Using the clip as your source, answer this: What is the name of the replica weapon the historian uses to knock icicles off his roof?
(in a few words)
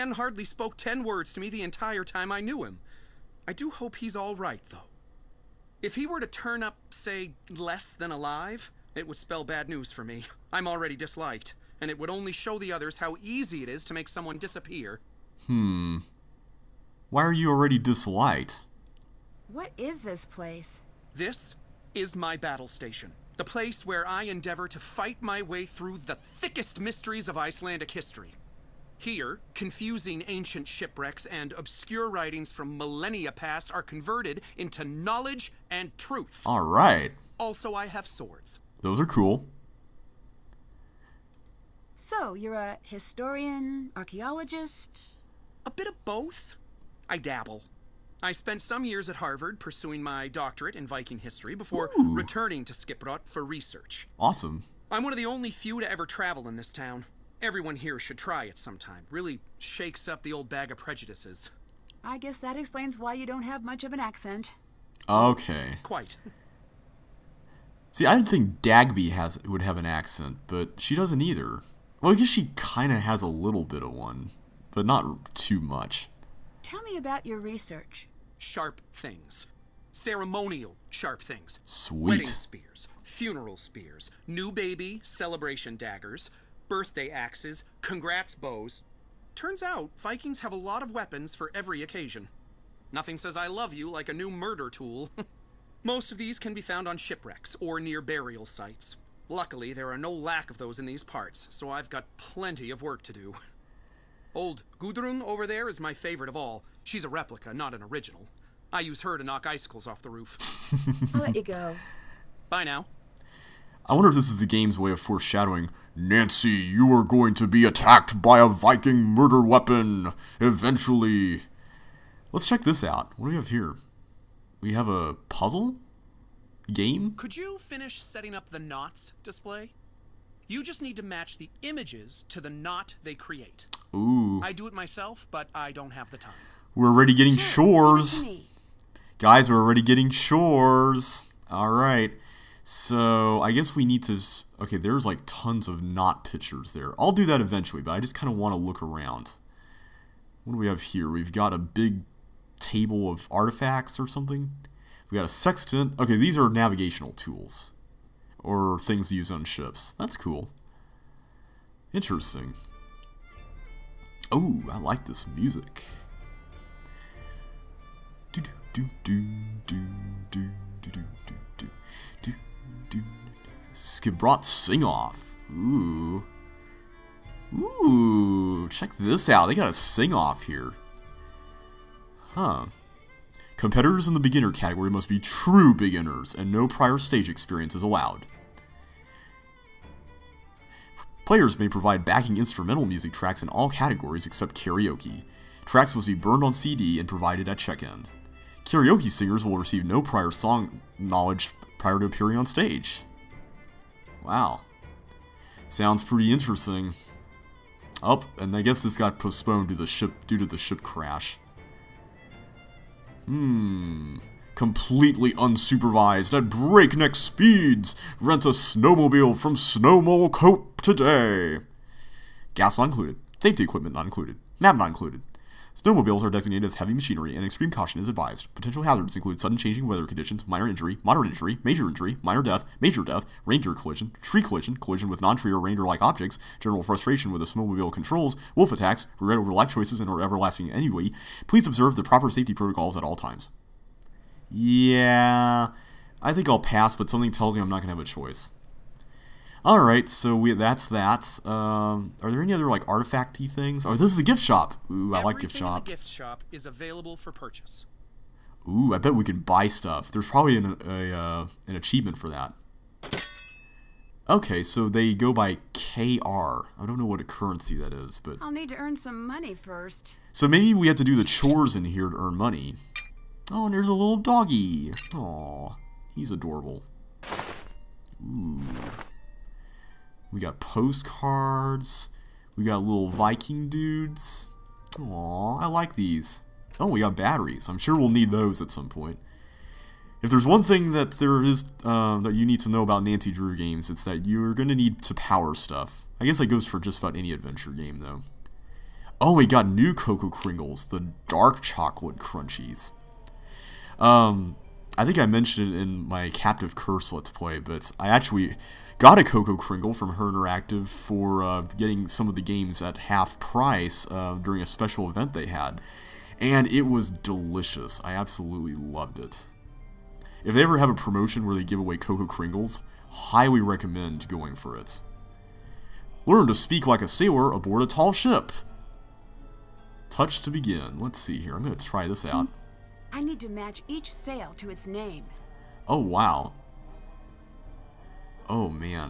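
Gudrun.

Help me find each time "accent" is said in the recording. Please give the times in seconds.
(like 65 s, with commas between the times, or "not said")
63 s, 69 s.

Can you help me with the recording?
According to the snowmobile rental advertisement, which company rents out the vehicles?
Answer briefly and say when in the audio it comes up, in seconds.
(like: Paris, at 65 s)
Snowmole Cope, at 219 s.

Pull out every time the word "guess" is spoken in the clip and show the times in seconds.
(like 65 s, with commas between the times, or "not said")
62 s, 72 s, 143 s, 208 s, 296 s.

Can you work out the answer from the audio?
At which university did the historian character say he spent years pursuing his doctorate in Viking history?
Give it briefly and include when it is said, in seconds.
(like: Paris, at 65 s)
Harvard, at 49 s.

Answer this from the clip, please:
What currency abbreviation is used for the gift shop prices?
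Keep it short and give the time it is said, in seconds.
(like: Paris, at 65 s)
KR, at 265 s.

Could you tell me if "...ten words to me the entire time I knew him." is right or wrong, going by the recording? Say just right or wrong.
right.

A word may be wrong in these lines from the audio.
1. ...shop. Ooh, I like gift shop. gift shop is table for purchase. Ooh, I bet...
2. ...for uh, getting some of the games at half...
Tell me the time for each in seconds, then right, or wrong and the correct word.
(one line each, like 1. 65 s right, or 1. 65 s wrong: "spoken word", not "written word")
1. 254 s wrong: "available", not "table"
2. 310 s right.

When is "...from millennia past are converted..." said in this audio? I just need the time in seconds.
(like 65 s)
32 s.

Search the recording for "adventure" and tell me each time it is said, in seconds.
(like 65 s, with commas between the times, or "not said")
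297 s.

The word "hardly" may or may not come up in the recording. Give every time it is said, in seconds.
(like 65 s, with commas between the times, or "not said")
0 s.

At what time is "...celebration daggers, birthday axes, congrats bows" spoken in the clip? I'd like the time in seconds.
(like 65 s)
85 s.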